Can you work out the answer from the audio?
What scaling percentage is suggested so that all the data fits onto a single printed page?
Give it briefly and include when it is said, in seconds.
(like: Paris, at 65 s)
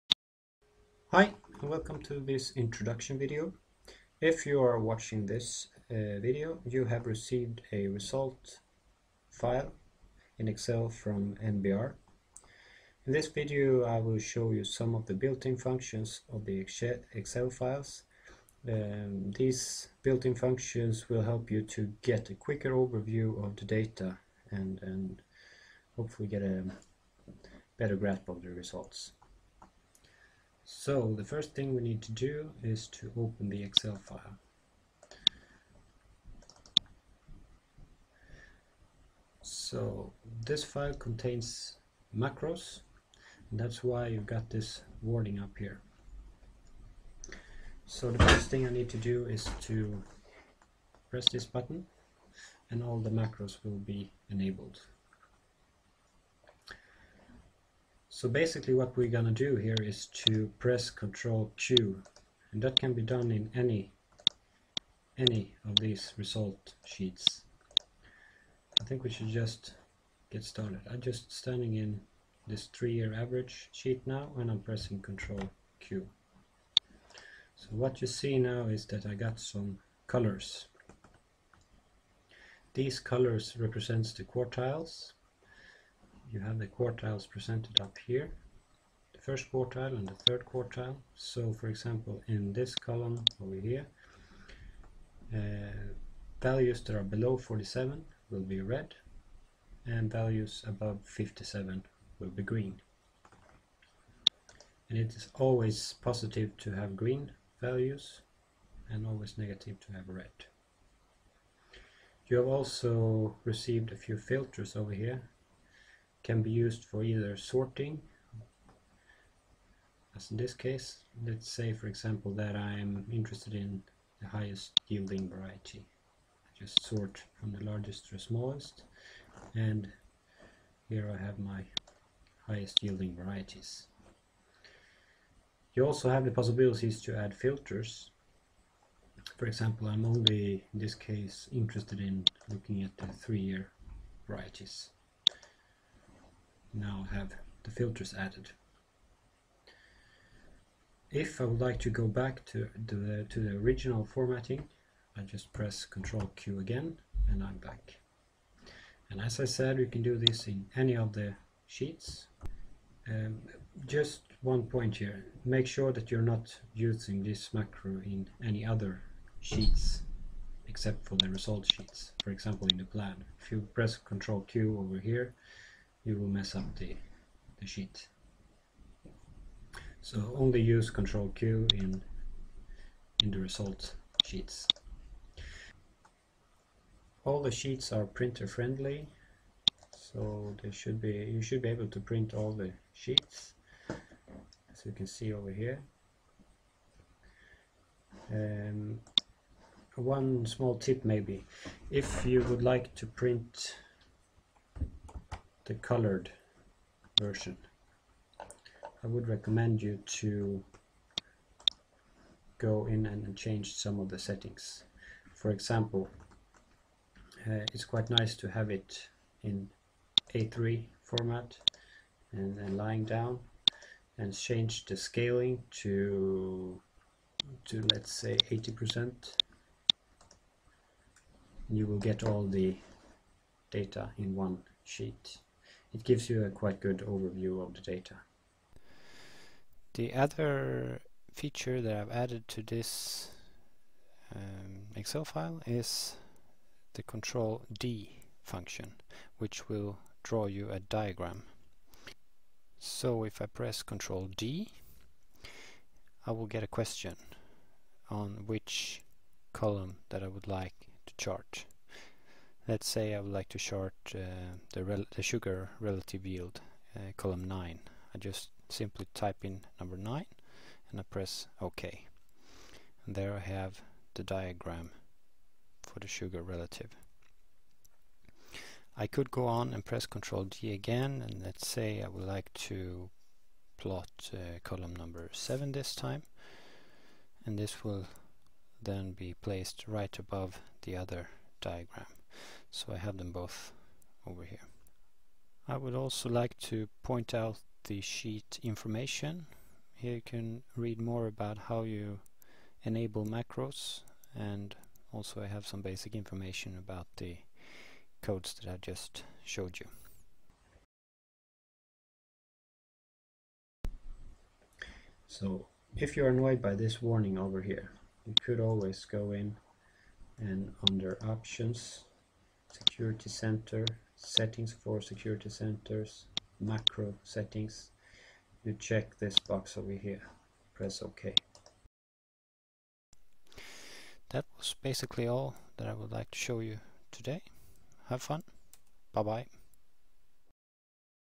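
80%, at 228 s.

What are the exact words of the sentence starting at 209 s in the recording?
I would recommend you to go in and change some of the settings.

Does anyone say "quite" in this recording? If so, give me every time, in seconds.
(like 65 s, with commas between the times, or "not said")
217 s, 236 s.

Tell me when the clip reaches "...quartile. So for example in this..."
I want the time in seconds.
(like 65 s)
90 s.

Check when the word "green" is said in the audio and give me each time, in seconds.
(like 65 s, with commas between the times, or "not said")
102 s, 106 s.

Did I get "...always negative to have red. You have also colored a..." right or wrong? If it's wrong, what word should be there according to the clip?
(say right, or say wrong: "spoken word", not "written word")
wrong: "received", not "colored".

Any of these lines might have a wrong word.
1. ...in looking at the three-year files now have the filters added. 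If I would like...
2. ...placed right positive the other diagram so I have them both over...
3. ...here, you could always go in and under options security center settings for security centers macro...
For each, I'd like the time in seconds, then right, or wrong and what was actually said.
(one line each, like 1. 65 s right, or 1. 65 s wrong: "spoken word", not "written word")
1. 141 s wrong: "varieties", not "files"
2. 289 s wrong: "above", not "positive"
3. 317 s right.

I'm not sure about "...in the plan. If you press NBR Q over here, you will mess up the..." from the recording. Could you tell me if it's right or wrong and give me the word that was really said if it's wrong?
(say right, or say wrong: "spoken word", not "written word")
wrong: "Ctrl", not "NBR".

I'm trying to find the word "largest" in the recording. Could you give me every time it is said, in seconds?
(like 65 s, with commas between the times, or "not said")
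127 s.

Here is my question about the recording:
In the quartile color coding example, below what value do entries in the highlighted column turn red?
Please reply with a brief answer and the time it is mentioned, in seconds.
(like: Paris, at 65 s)
47, at 97 s.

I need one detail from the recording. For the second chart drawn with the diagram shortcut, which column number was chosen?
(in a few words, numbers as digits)
7.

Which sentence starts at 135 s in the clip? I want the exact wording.
You also have the possibilities to add filters.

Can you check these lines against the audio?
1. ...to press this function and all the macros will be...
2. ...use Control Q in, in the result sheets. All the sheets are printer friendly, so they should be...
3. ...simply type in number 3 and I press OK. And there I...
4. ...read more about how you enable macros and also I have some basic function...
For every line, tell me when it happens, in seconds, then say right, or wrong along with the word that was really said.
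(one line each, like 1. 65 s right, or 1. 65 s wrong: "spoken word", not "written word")
1. 49 s wrong: "button", not "function"
2. 180 s right
3. 268 s wrong: "9", not "3"
4. 300 s wrong: "information", not "function".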